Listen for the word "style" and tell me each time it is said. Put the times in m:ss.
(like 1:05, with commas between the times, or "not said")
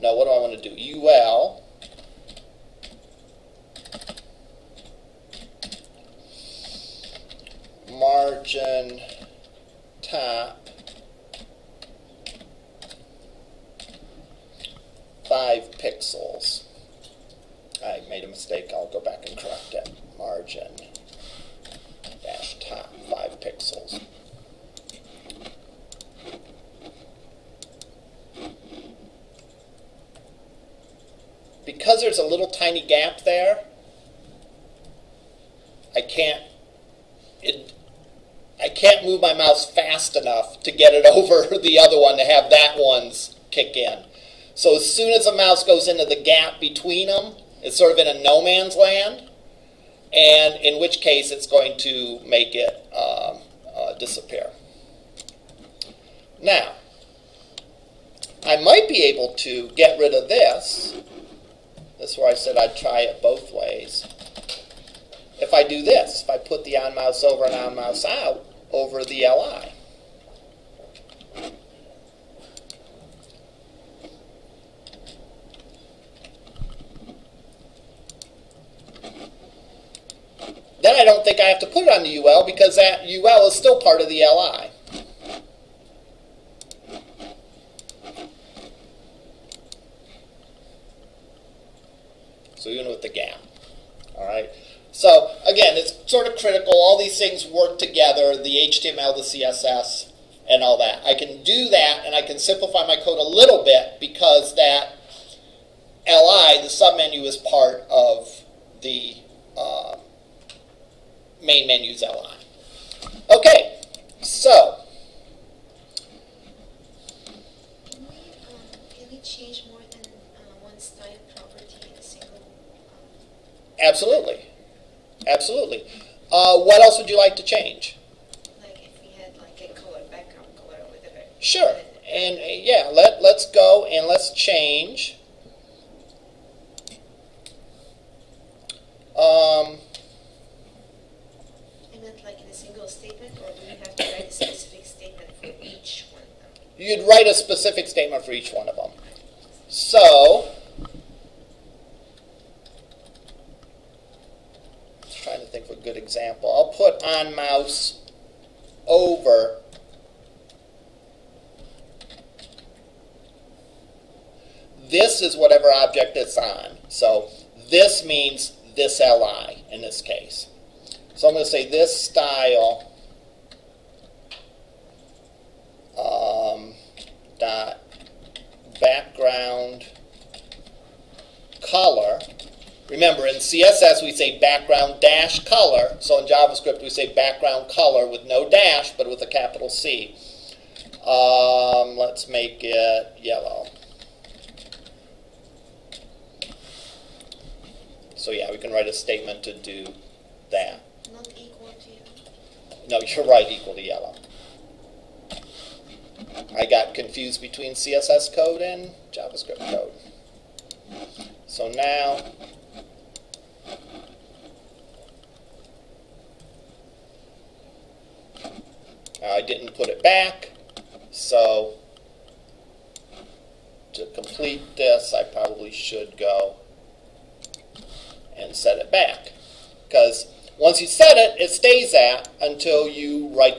2:00, 2:52.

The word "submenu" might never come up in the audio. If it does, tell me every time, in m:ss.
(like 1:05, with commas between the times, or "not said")
1:46.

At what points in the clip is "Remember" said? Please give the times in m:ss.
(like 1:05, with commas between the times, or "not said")
3:02.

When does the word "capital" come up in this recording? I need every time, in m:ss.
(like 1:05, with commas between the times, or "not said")
3:09.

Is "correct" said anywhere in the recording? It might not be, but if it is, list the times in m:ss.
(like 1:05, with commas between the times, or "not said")
0:19.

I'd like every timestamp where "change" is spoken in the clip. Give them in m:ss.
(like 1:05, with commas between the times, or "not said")
1:59, 2:07, 2:14.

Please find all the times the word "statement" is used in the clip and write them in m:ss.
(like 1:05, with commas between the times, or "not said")
2:27, 3:18.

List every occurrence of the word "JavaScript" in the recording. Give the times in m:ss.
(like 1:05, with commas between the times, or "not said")
3:06, 3:29.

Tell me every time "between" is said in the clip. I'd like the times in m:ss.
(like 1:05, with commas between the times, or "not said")
0:46, 3:27.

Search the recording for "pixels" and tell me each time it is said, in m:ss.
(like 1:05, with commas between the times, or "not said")
0:15, 0:23.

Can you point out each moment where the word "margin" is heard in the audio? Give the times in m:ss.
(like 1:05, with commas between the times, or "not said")
0:07, 0:20.